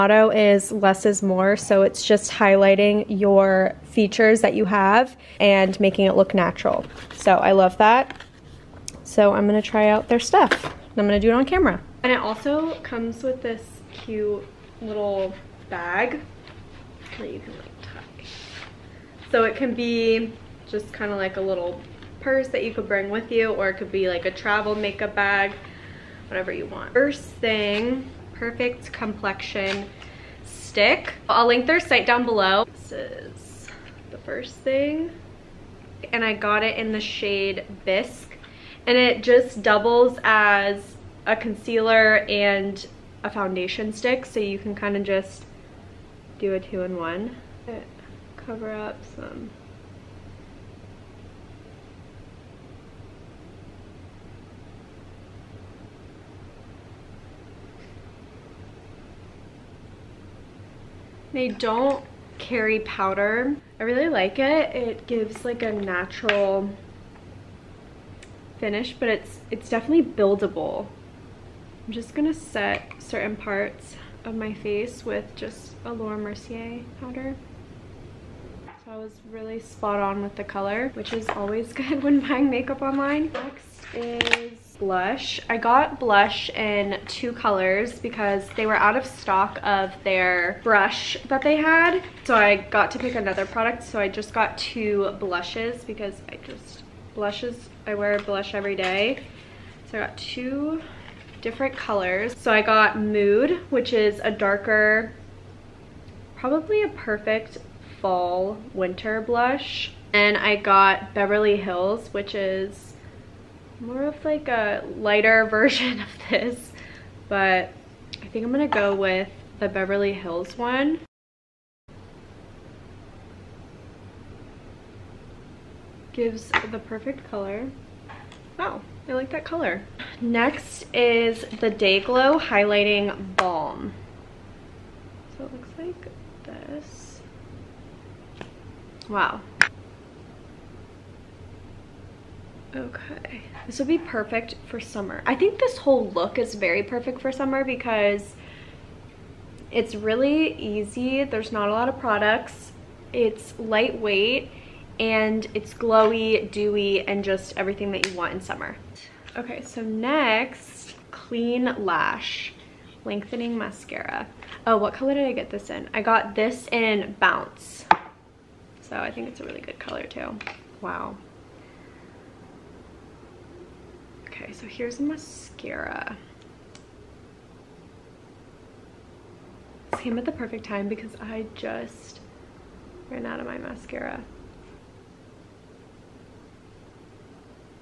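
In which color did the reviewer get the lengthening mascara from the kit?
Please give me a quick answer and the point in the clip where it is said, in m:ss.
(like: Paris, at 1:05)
Bounce, at 2:47.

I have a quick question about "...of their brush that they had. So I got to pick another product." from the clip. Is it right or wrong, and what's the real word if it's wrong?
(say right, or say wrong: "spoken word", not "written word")
right.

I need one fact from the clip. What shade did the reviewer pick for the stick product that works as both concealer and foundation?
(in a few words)
Bisque.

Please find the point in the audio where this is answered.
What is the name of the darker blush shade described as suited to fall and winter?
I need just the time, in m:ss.
1:42.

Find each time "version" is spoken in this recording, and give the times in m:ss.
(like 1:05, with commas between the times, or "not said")
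1:55.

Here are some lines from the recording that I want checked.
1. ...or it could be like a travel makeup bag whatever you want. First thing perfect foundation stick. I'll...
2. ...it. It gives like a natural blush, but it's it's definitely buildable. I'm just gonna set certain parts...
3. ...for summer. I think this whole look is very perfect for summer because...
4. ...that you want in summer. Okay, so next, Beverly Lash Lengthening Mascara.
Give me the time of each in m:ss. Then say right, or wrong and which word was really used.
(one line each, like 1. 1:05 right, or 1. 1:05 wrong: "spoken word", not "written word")
1. 0:23 wrong: "complexion", not "foundation"
2. 1:04 wrong: "finish", not "blush"
3. 2:24 right
4. 2:37 wrong: "Clean", not "Beverly".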